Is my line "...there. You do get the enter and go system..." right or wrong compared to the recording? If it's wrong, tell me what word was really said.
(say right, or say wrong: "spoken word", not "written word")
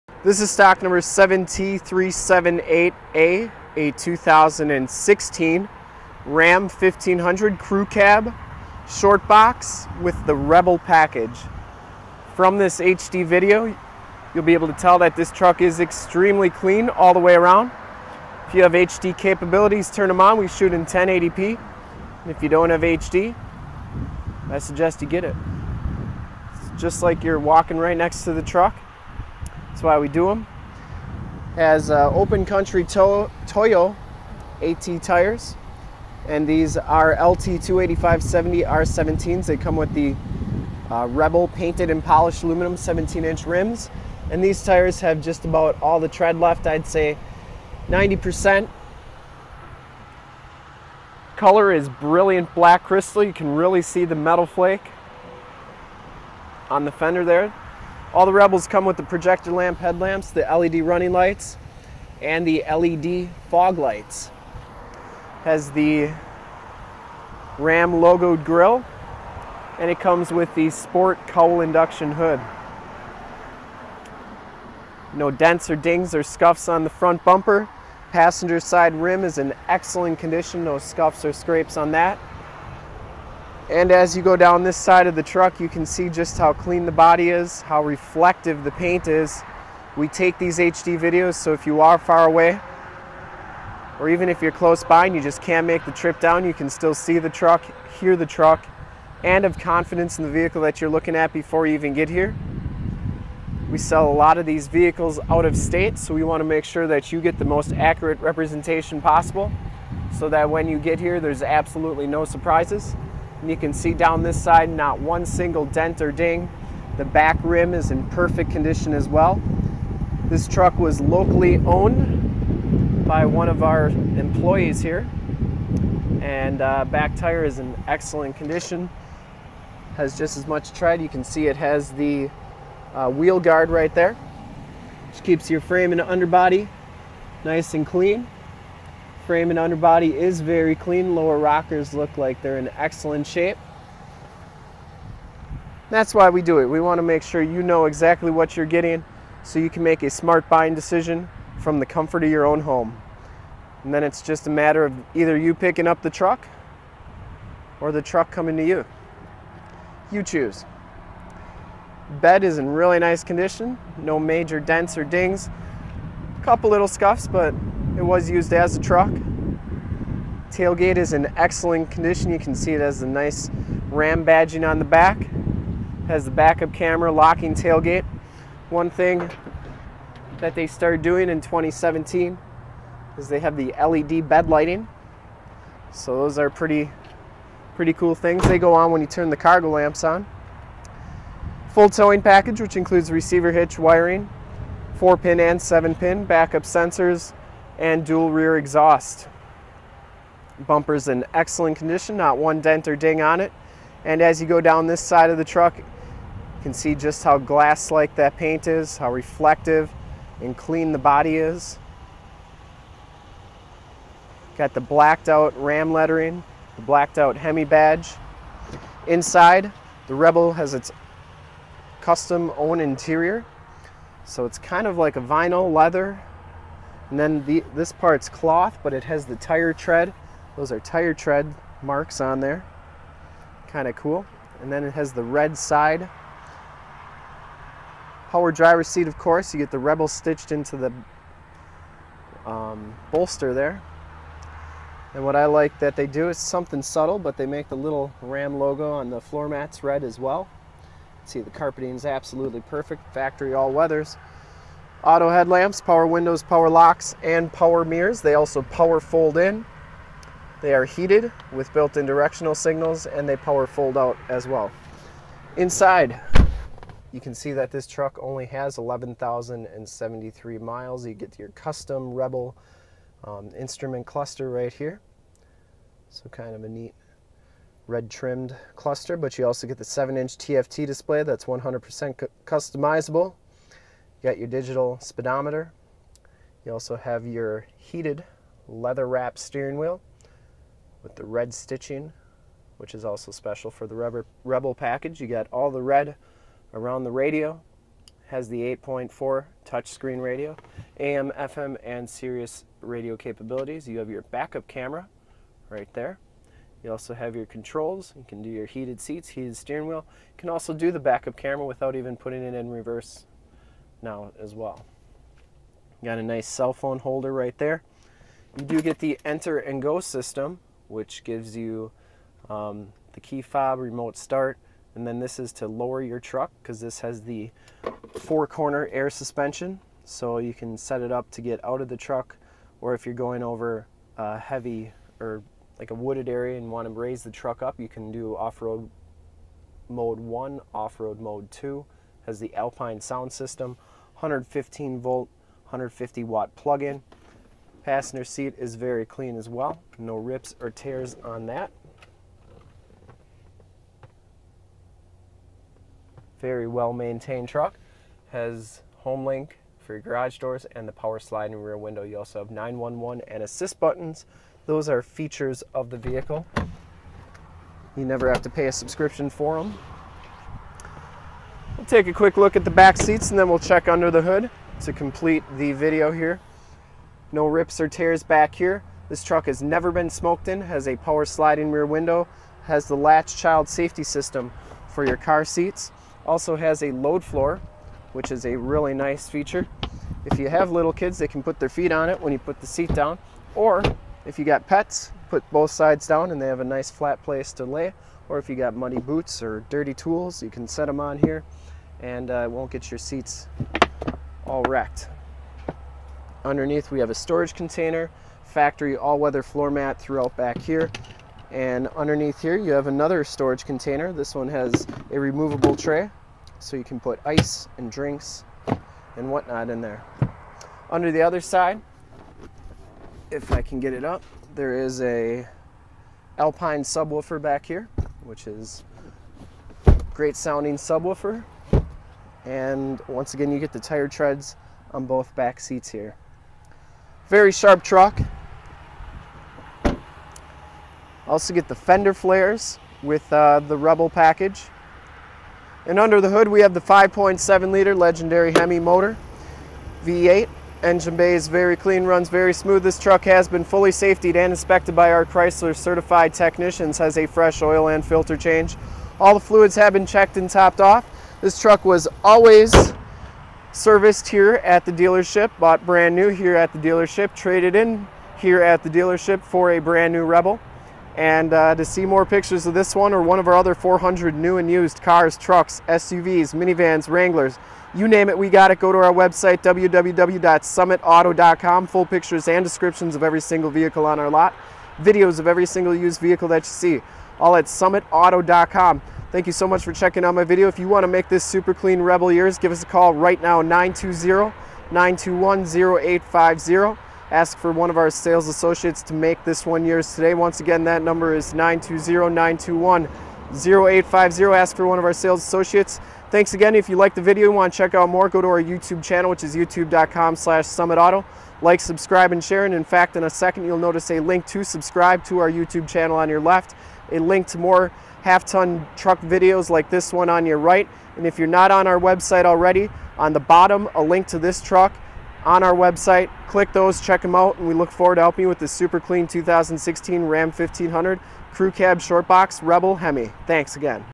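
right.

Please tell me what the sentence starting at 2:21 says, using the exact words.
Lower rockers look like they're in excellent shape.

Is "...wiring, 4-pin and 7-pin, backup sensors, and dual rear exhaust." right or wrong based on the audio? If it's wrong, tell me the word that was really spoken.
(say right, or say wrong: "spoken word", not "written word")
right.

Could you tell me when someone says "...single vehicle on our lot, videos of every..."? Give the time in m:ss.
8:03.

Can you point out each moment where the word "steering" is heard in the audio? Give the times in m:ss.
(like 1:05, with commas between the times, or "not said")
4:49, 5:09.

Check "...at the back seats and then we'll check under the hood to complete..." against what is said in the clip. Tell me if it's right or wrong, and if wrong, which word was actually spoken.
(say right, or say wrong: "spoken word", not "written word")
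right.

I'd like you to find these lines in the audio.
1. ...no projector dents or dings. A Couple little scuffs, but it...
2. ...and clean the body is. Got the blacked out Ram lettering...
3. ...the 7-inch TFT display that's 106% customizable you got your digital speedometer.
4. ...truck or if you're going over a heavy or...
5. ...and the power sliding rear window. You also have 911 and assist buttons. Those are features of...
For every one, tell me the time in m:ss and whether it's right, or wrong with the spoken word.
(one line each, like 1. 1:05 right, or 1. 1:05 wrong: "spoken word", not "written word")
1. 2:43 wrong: "major", not "projector"
2. 3:30 right
3. 4:39 wrong: "100", not "106"
4. 5:31 right
5. 6:00 right.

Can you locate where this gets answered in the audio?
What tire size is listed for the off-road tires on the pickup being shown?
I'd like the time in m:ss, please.
0:37.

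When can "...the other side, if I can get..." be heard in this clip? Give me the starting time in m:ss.
7:01.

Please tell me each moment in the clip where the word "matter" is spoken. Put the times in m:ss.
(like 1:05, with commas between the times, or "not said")
2:34.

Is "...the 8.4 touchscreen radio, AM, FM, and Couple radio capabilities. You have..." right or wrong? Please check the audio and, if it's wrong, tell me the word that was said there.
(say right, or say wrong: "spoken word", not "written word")
wrong: "Sirius", not "Couple".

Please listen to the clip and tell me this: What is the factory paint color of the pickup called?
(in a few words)
Brilliant black crystal.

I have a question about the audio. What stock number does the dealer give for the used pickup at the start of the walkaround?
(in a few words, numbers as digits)
7378.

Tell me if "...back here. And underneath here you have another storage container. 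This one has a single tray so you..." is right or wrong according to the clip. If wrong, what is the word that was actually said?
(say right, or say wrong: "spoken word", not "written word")
wrong: "removable", not "single".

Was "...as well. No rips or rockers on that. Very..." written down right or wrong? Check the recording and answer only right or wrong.
wrong.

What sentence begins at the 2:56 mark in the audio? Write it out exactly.
has the backup camera, locking tailgate.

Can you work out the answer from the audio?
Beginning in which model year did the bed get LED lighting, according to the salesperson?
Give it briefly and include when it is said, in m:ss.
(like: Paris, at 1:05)
2017, at 3:01.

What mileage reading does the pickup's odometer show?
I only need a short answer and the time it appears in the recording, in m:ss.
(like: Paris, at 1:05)
11,073, at 4:28.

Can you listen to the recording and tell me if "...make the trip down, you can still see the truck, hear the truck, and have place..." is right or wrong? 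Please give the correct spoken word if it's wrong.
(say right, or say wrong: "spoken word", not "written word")
wrong: "confidence", not "place".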